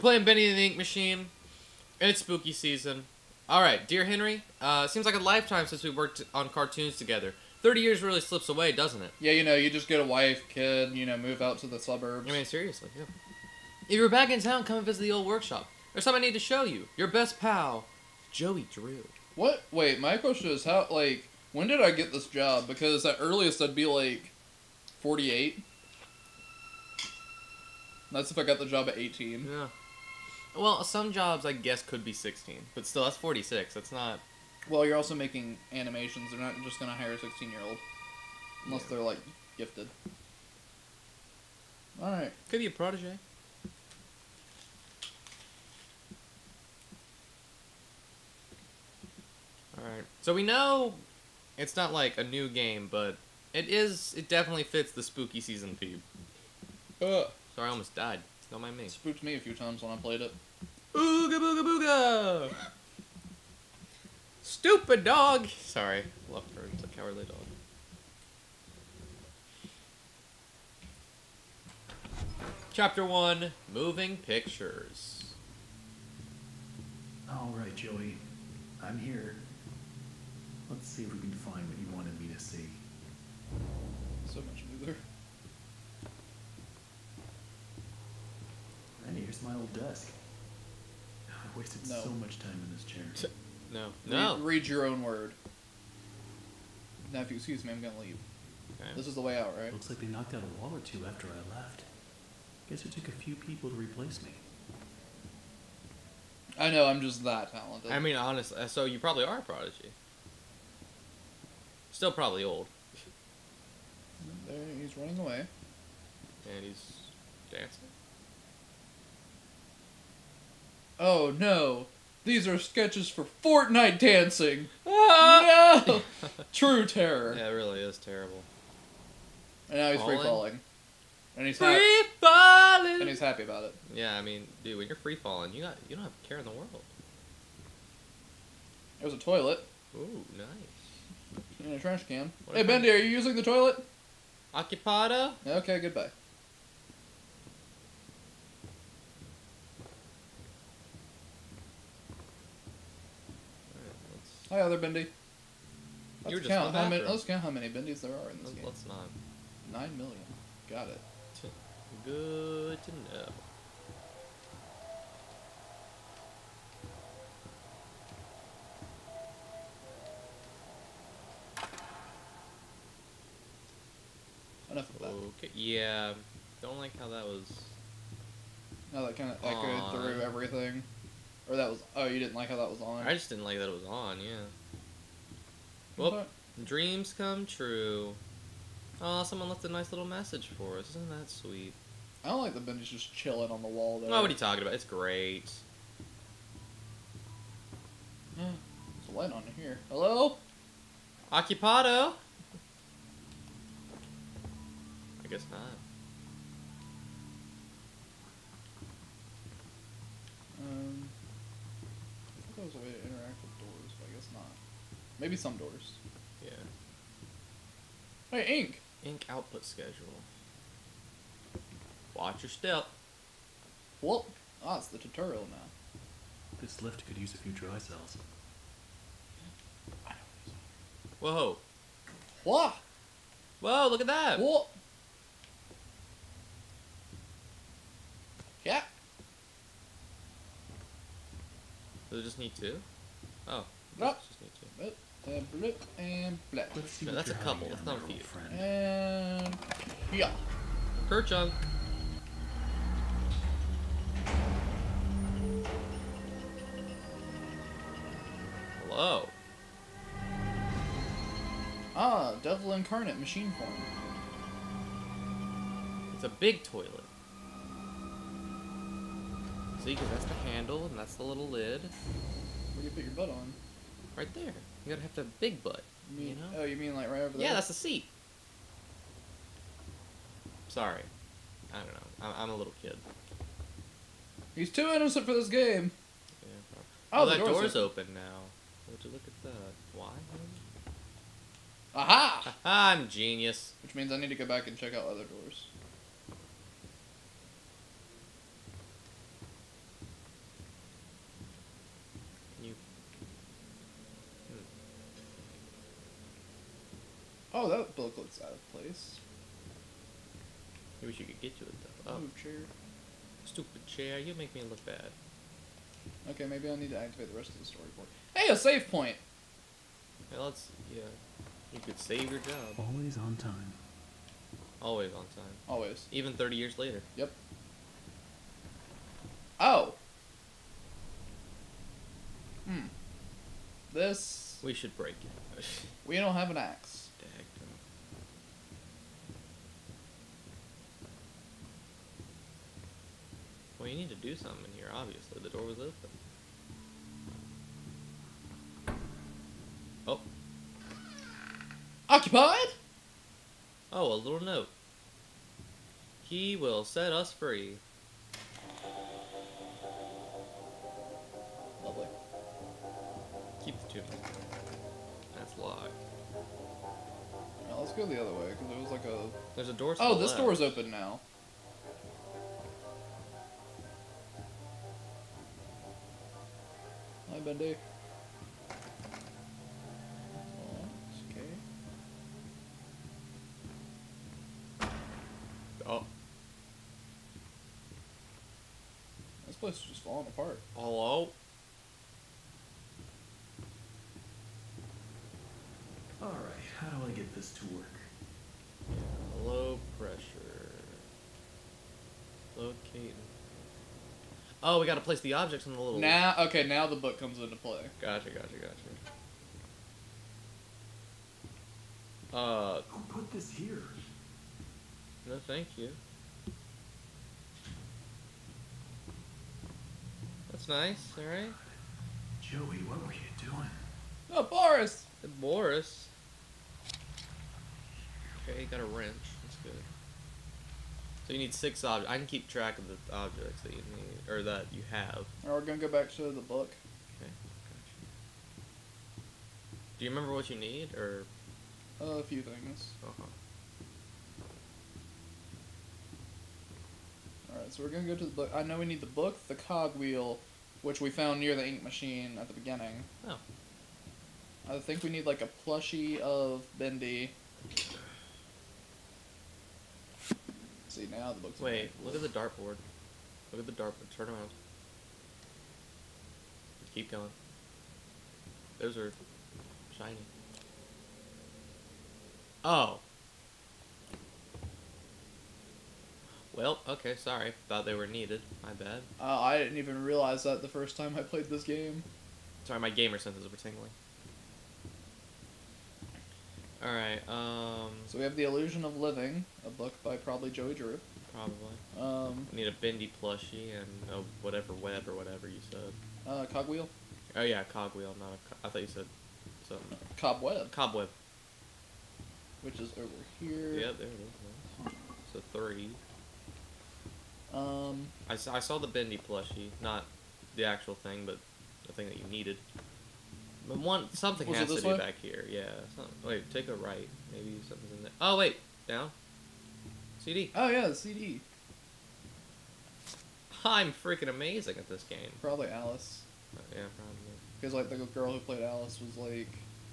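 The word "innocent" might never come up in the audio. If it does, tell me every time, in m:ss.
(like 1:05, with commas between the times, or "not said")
4:44.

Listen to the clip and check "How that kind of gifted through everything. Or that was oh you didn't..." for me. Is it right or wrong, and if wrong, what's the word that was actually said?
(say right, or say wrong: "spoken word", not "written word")
wrong: "echoed", not "gifted".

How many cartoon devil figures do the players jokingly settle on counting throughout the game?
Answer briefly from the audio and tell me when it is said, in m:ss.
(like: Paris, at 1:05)
Nine million, at 2:39.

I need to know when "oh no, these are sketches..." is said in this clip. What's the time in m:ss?
2:00.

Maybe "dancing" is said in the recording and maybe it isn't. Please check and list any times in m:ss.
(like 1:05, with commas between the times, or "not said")
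1:57, 2:03.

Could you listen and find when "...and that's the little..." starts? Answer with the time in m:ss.
4:30.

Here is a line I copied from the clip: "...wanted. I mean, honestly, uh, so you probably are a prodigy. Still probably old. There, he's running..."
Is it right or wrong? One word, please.
wrong.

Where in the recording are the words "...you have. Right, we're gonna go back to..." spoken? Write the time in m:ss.
7:14.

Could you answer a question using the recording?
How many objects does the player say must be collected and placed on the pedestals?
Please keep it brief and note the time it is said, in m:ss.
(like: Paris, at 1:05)
6, at 7:11.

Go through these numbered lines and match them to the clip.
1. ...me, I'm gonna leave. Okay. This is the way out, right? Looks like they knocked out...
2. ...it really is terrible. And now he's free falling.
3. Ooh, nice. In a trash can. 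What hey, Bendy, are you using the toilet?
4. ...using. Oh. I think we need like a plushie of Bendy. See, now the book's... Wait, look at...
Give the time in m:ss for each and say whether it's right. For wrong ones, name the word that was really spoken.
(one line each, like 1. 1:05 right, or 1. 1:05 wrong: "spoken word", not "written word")
1. 1:37 right
2. 2:07 right
3. 2:19 right
4. 7:32 wrong: "beginning", not "using".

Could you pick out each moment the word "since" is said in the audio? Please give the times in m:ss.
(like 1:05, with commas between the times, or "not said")
0:05.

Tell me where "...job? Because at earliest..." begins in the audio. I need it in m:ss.
0:22.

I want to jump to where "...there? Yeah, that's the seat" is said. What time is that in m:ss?
4:37.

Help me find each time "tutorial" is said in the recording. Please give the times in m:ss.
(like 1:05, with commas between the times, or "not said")
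3:44.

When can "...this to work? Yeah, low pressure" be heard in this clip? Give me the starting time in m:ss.
6:37.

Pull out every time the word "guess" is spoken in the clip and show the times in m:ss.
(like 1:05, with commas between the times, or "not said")
0:31, 1:42, 3:25, 3:34.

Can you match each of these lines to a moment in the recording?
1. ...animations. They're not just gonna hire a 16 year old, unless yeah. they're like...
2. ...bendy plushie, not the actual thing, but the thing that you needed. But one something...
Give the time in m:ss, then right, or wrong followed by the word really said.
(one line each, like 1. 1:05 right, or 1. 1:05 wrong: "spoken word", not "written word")
1. 0:35 right
2. 8:28 right.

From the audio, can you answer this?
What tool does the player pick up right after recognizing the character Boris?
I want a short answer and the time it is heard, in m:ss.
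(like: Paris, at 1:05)
wrench, at 7:08.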